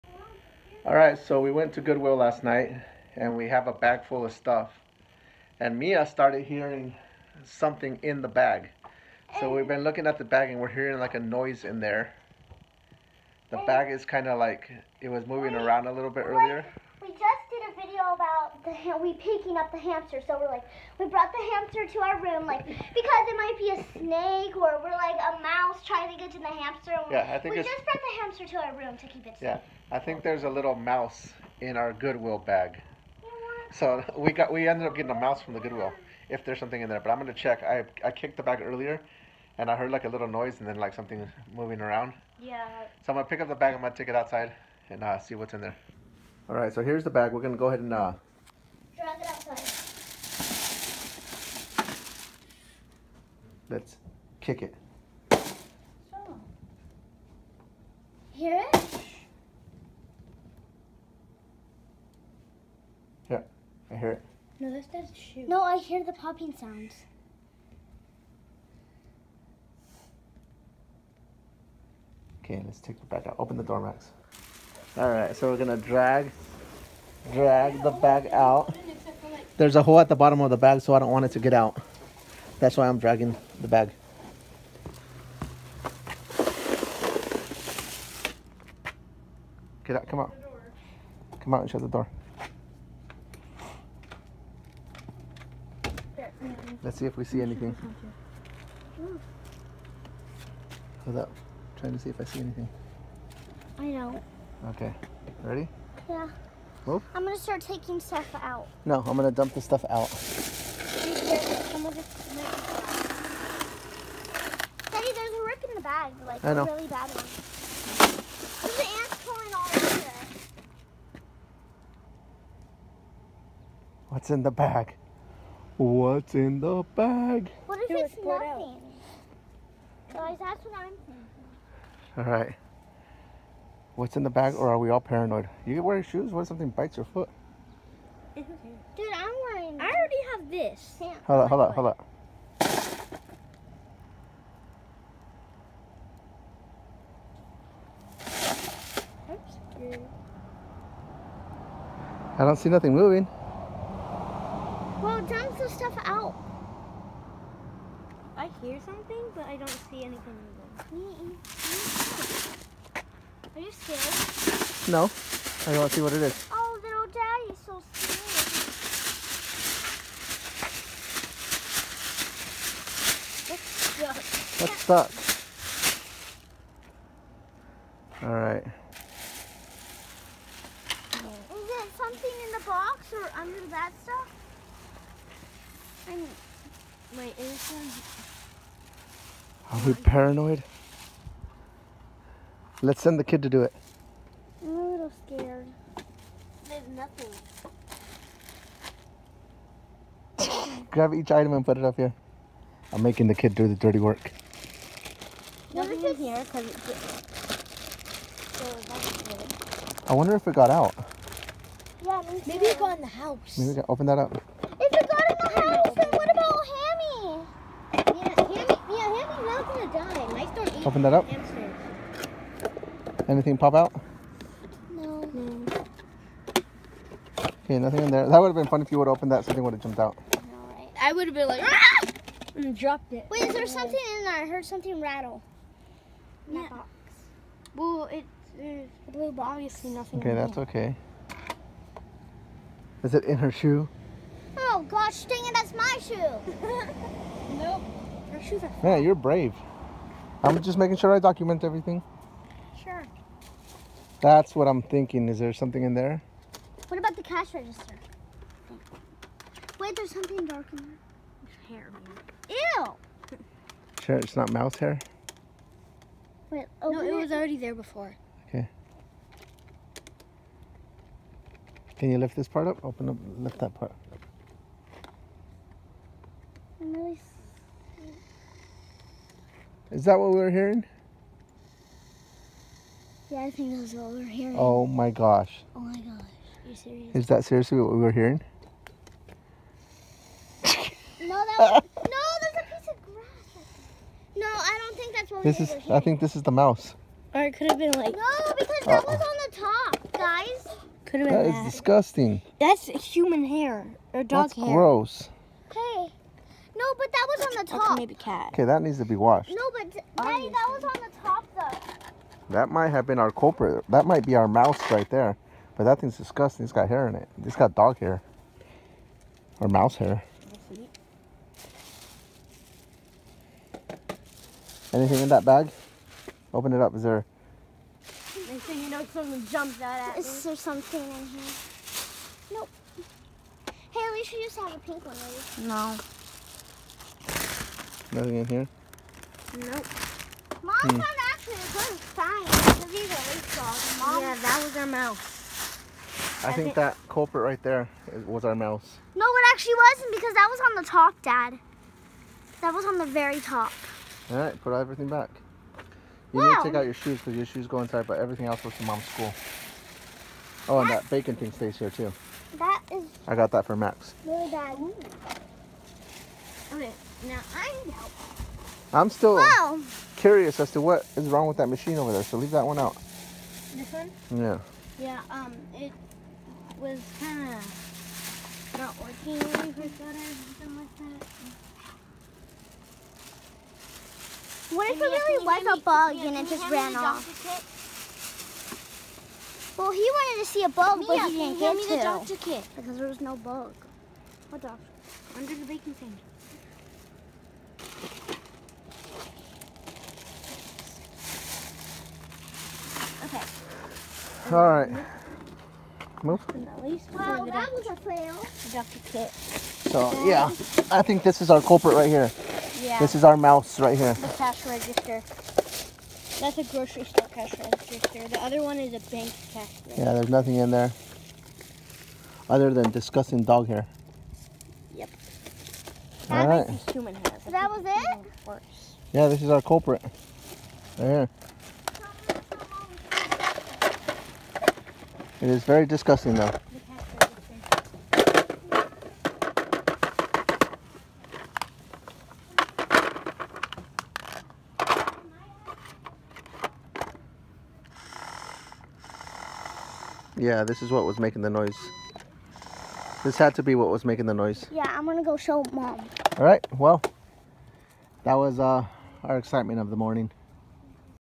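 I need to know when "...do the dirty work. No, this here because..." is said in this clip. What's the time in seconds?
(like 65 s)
203 s.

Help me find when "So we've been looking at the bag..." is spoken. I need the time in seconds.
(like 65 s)
9 s.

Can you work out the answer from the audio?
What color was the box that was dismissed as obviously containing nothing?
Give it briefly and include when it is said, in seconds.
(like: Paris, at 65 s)
blue, at 238 s.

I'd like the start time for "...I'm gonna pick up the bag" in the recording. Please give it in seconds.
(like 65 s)
43 s.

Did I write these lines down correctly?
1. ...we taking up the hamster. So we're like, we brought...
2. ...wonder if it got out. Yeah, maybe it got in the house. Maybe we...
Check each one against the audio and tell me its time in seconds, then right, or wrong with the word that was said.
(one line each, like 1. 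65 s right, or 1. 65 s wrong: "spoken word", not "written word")
1. 19 s wrong: "picking", not "taking"
2. 210 s right.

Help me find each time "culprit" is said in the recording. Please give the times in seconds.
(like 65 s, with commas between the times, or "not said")
313 s, 347 s, 411 s, 429 s.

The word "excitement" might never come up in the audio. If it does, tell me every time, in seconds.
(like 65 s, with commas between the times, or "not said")
459 s.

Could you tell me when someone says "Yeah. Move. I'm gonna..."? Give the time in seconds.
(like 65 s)
106 s.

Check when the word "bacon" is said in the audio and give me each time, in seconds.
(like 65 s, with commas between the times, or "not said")
361 s.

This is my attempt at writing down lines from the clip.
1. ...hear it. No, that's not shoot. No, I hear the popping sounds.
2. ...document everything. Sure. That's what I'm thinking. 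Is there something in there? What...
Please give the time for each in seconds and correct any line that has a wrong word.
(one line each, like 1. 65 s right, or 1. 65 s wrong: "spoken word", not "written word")
1. 63 s right
2. 251 s right.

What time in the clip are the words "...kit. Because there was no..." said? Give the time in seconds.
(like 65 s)
392 s.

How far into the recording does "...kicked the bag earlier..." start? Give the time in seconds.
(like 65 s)
38 s.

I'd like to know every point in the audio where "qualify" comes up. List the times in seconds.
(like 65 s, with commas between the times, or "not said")
not said.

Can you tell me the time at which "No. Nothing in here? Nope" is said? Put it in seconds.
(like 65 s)
335 s.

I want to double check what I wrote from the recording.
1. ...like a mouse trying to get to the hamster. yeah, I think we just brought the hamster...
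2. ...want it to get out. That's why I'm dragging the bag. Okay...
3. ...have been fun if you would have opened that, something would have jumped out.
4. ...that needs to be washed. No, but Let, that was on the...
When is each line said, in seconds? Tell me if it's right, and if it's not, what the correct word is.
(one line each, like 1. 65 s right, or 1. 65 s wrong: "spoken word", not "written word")
1. 24 s right
2. 81 s right
3. 228 s right
4. 308 s wrong: "Daddy", not "Let".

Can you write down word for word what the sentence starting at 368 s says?
I'm still curious as to what is wrong with that machine over there, so leave that one out.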